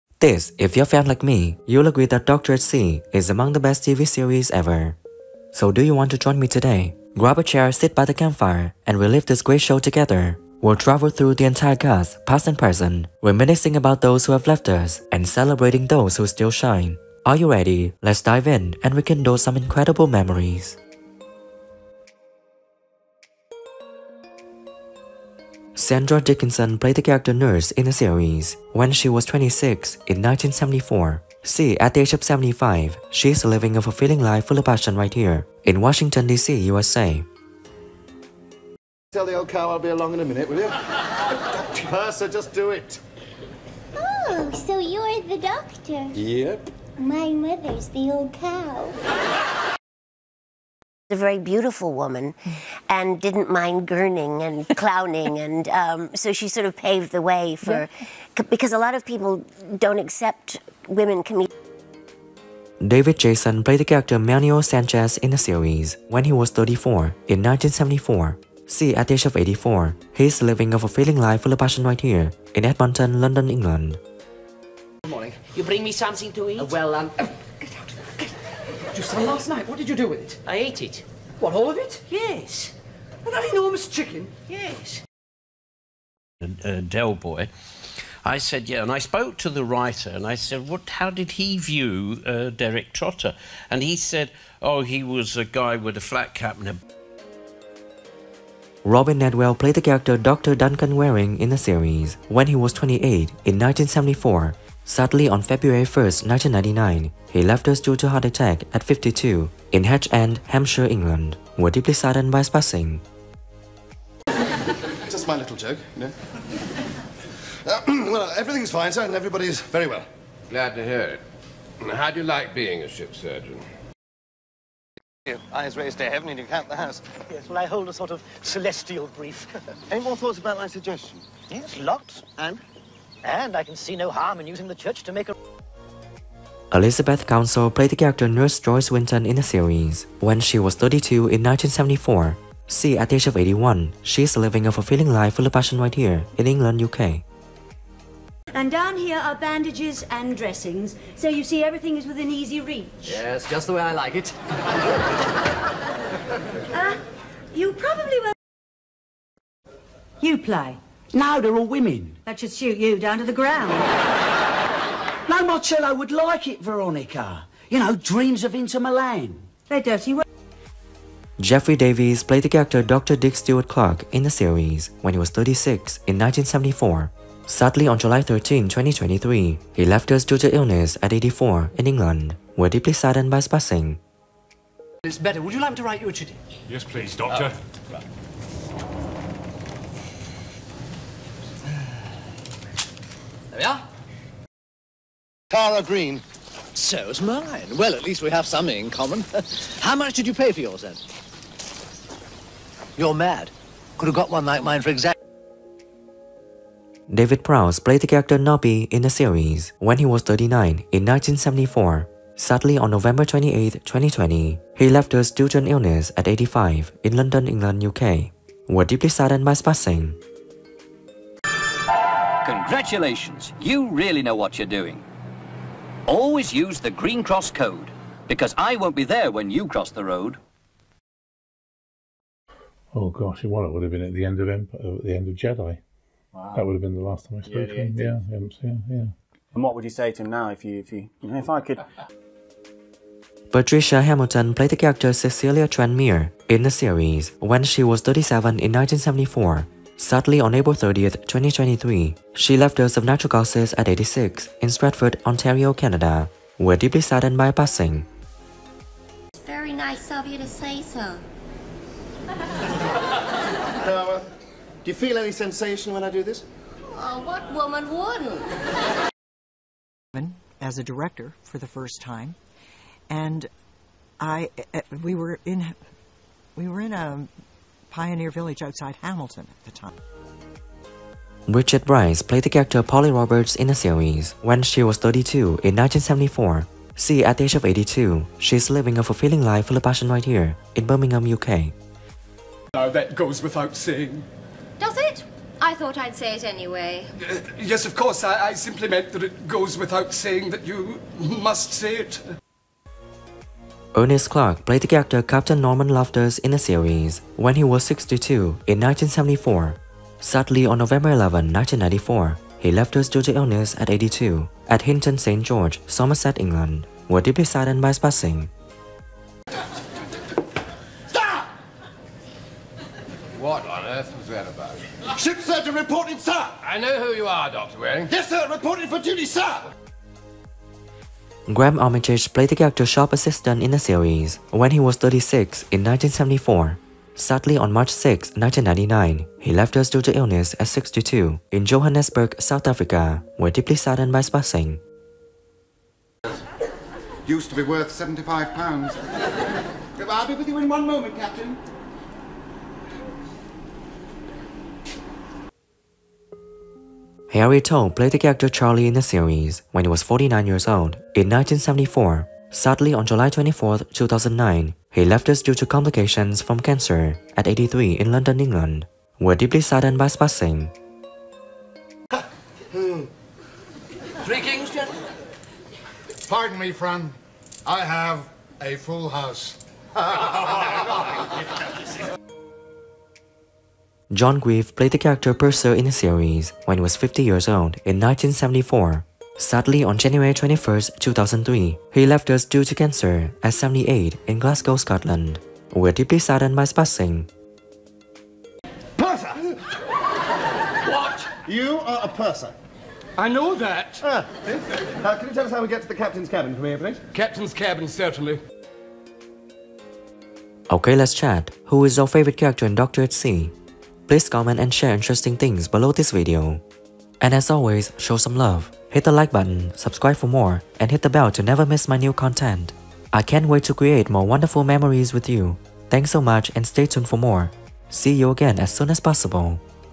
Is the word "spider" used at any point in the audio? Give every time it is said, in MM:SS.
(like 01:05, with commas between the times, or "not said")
not said.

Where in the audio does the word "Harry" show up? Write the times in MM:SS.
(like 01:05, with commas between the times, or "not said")
05:57.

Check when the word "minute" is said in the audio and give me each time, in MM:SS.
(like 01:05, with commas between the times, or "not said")
00:40.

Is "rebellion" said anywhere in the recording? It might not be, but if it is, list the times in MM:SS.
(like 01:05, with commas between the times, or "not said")
not said.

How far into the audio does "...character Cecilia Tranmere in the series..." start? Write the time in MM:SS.
04:04.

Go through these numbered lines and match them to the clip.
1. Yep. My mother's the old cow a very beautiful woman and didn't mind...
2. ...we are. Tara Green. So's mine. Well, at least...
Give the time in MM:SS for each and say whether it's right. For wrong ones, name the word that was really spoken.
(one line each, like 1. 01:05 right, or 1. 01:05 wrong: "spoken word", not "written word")
1. 00:46 right
2. 03:13 right.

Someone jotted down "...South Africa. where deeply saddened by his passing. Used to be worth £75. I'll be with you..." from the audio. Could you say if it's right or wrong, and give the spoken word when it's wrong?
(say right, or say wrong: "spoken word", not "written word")
right.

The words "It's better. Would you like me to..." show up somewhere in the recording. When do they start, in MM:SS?
03:05.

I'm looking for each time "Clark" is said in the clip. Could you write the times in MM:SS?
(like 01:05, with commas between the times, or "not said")
02:53, 05:04.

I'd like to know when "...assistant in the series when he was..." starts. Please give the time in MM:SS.
05:33.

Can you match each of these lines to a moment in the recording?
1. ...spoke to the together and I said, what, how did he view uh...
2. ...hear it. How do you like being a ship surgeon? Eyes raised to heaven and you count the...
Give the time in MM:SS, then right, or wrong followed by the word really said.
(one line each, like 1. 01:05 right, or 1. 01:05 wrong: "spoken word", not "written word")
1. 01:28 wrong: "writer", not "together"
2. 02:00 right.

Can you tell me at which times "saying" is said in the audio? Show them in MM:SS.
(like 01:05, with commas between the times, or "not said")
04:53, 05:00.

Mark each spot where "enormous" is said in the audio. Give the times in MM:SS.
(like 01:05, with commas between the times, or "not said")
01:23.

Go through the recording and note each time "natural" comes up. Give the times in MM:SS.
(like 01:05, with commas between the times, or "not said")
04:13.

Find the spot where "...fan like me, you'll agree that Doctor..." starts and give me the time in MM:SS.
00:00.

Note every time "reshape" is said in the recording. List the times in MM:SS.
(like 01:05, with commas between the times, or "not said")
not said.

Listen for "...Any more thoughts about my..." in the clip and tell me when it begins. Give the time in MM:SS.
02:09.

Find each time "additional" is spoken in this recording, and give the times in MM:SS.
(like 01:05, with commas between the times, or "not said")
not said.